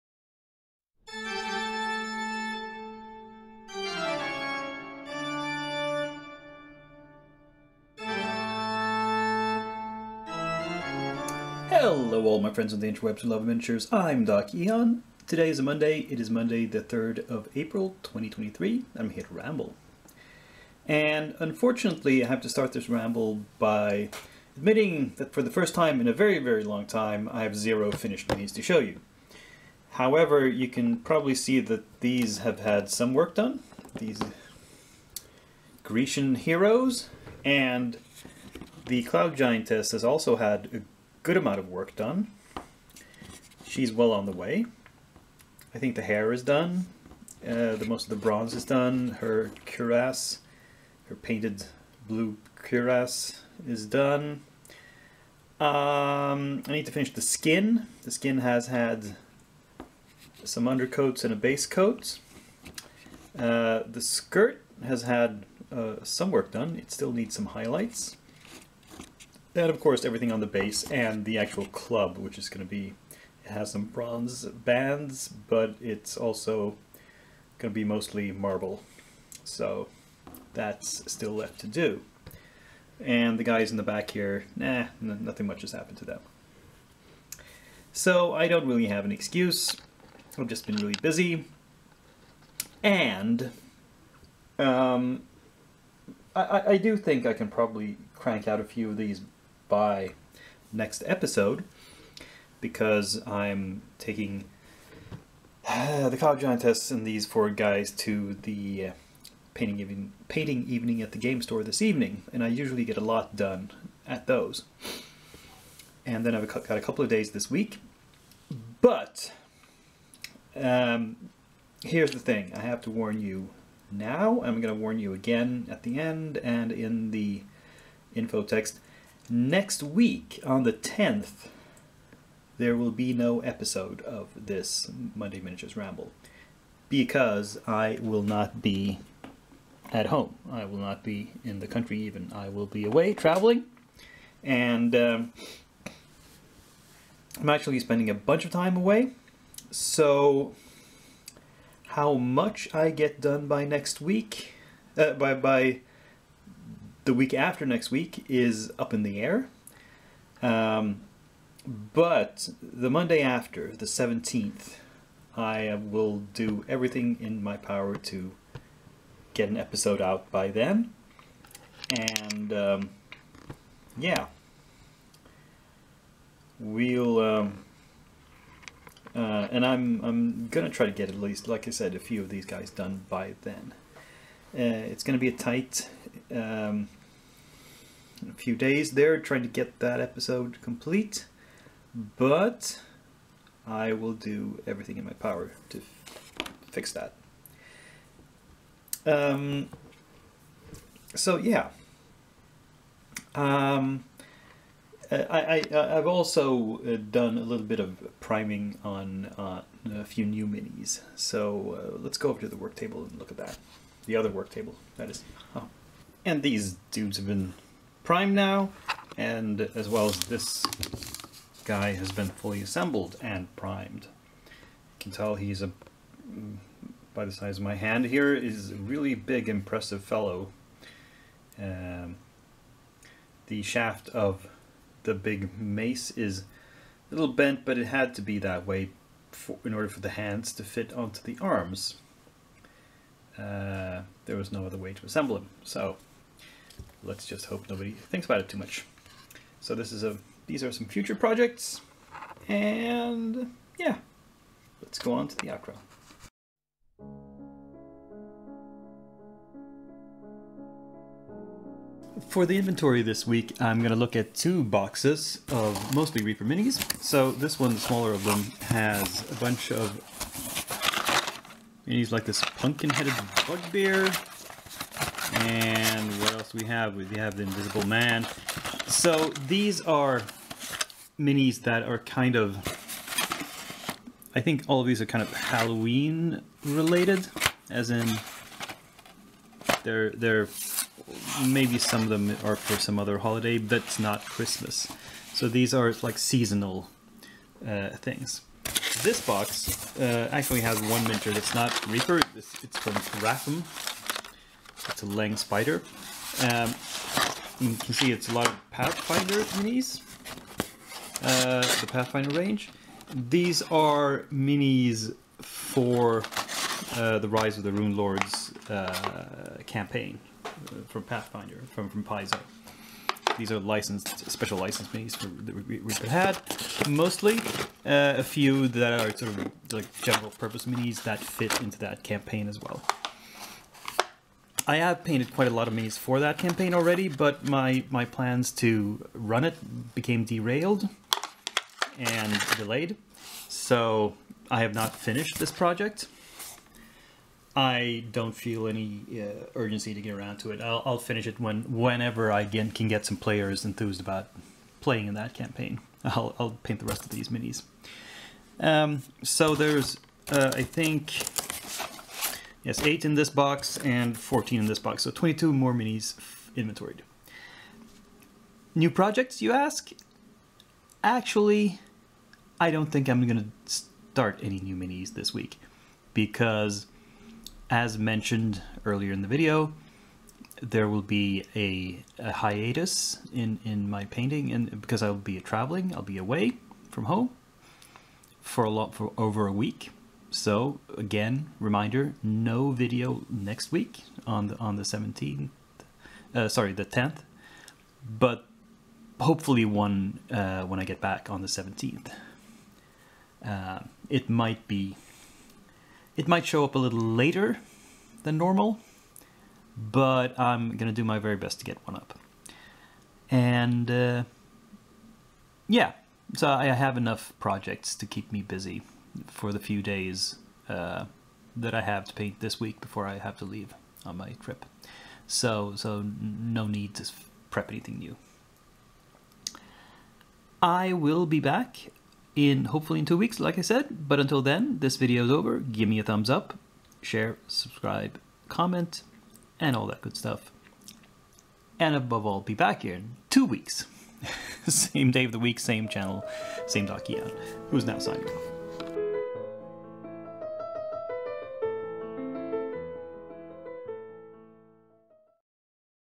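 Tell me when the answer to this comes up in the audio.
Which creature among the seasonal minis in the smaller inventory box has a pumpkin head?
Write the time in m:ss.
4:32.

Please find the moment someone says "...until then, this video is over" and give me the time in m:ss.
7:14.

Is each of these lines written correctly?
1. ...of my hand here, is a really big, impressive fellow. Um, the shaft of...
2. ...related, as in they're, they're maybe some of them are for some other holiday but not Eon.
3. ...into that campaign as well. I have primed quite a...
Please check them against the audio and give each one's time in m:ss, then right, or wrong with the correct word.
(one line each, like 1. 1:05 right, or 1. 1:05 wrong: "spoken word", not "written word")
1. 3:47 right
2. 4:46 wrong: "Christmas", not "Eon"
3. 5:31 wrong: "painted", not "primed".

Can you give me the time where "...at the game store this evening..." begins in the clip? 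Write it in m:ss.
1:51.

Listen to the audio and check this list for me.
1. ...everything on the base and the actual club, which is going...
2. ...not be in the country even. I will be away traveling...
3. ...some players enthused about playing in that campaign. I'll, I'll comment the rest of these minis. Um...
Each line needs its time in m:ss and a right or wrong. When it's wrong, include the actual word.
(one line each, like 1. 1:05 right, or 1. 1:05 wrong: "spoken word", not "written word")
1. 1:10 right
2. 2:20 right
3. 5:53 wrong: "paint", not "comment".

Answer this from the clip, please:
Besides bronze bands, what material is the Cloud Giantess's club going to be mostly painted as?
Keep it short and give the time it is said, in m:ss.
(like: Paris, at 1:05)
Marble, at 1:18.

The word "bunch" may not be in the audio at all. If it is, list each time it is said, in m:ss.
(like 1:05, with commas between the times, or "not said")
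2:28, 4:29.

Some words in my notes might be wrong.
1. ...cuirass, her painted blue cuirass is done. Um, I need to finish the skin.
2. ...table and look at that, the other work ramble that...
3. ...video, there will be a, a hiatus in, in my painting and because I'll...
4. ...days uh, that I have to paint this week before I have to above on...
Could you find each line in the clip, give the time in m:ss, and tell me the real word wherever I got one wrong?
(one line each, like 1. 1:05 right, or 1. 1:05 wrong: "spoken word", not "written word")
1. 0:49 right
2. 3:32 wrong: "table", not "ramble"
3. 6:19 right
4. 6:59 wrong: "leave", not "above".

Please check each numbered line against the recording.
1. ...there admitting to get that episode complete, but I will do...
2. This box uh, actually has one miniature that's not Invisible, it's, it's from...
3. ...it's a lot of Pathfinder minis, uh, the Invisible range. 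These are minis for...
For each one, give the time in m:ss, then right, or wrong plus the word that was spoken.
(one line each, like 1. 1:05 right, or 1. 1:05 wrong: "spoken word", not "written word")
1. 3:08 wrong: "trying", not "admitting"
2. 4:59 wrong: "Reaper", not "Invisible"
3. 5:08 wrong: "Pathfinder", not "Invisible".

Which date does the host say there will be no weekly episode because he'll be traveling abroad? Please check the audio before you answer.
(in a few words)
10th.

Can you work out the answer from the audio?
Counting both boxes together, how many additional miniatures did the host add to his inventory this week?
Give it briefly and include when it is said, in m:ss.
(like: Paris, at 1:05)
22, at 6:05.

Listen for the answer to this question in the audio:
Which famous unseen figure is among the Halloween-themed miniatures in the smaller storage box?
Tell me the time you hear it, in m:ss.
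4:37.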